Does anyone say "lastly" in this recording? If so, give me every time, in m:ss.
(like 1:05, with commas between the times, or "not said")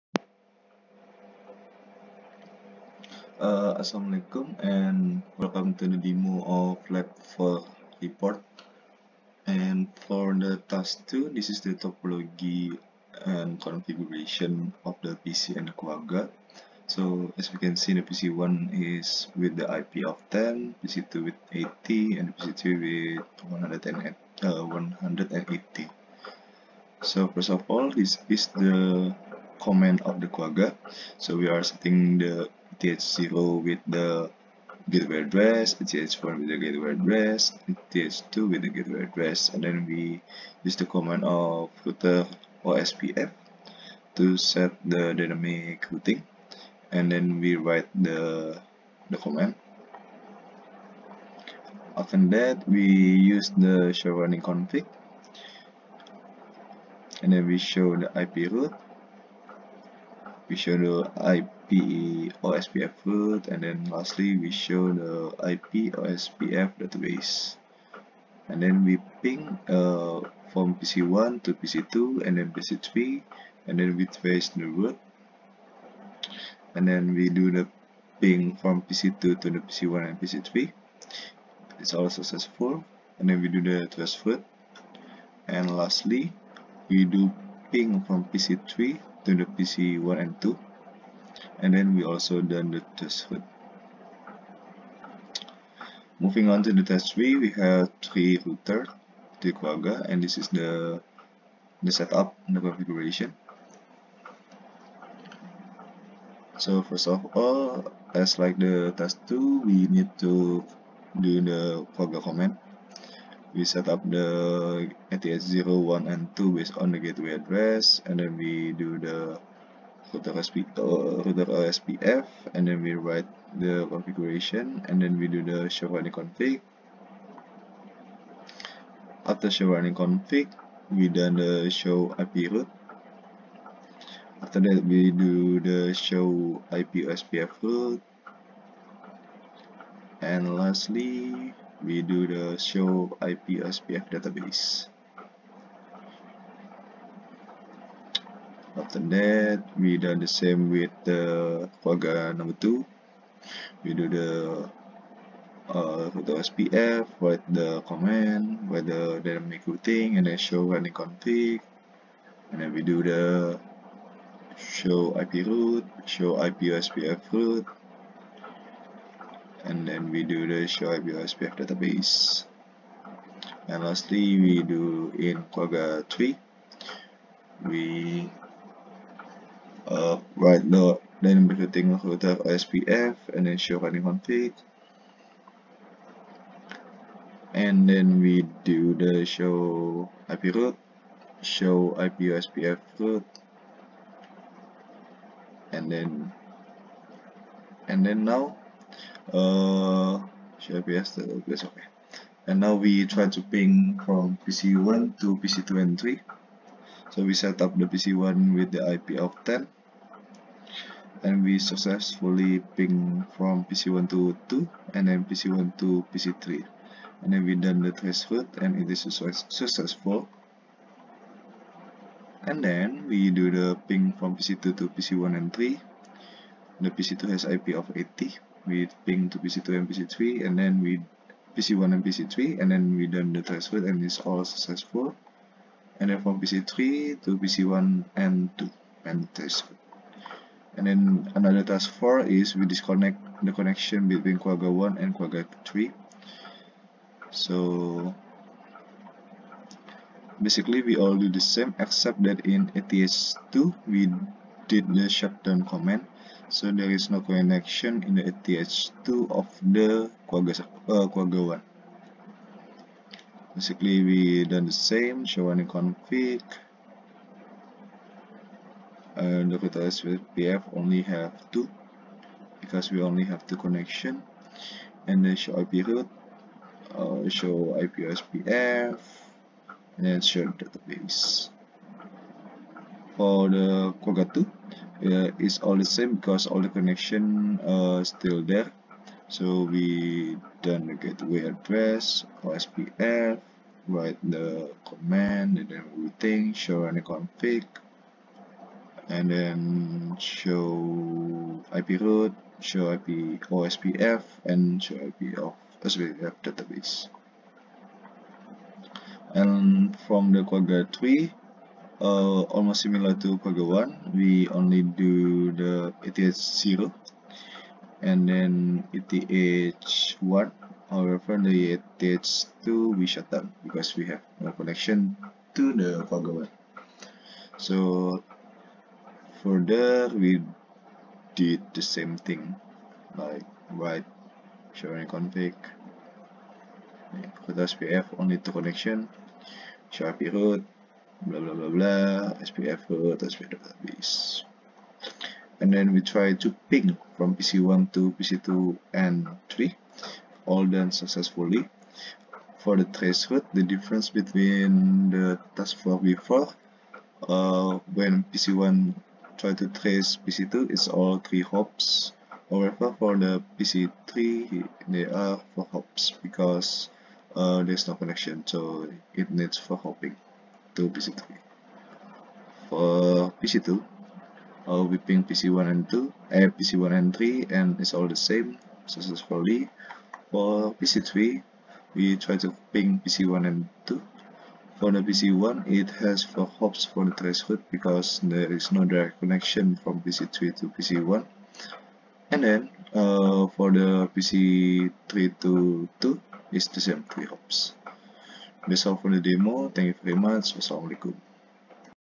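1:03, 1:25, 2:20, 2:53.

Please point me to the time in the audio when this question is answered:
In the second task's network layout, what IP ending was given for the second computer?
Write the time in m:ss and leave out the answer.
0:20.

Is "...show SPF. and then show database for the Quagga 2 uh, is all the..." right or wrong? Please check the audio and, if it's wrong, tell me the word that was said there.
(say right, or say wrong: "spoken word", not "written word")
right.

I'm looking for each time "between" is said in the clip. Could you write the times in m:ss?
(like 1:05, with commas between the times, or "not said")
4:04, 5:54.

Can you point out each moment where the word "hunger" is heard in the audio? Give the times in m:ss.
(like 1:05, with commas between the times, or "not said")
not said.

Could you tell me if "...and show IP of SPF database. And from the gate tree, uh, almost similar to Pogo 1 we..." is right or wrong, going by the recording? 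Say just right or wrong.
wrong.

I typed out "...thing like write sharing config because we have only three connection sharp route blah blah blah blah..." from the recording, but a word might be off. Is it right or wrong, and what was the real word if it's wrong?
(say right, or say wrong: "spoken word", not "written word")
wrong: "two", not "three".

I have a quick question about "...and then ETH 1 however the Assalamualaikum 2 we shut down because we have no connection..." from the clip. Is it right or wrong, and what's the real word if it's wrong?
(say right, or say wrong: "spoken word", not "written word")
wrong: "ETH", not "Assalamualaikum".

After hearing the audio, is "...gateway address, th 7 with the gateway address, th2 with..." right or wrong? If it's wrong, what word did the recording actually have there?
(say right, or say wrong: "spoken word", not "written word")
wrong: "4", not "7".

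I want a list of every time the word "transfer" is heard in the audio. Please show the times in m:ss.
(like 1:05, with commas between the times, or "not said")
3:53, 3:59.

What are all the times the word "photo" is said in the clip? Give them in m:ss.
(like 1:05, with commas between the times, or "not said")
2:36.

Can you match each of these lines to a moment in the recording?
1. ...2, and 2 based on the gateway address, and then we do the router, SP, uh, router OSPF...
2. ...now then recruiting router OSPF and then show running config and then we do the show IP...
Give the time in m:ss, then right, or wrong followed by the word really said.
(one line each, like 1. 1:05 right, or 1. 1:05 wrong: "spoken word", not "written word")
1. 1:55 wrong: "1", not "2"
2. 3:00 wrong: "SPF", not "OSPF".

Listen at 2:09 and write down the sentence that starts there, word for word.
After show running config, we done the show IP route.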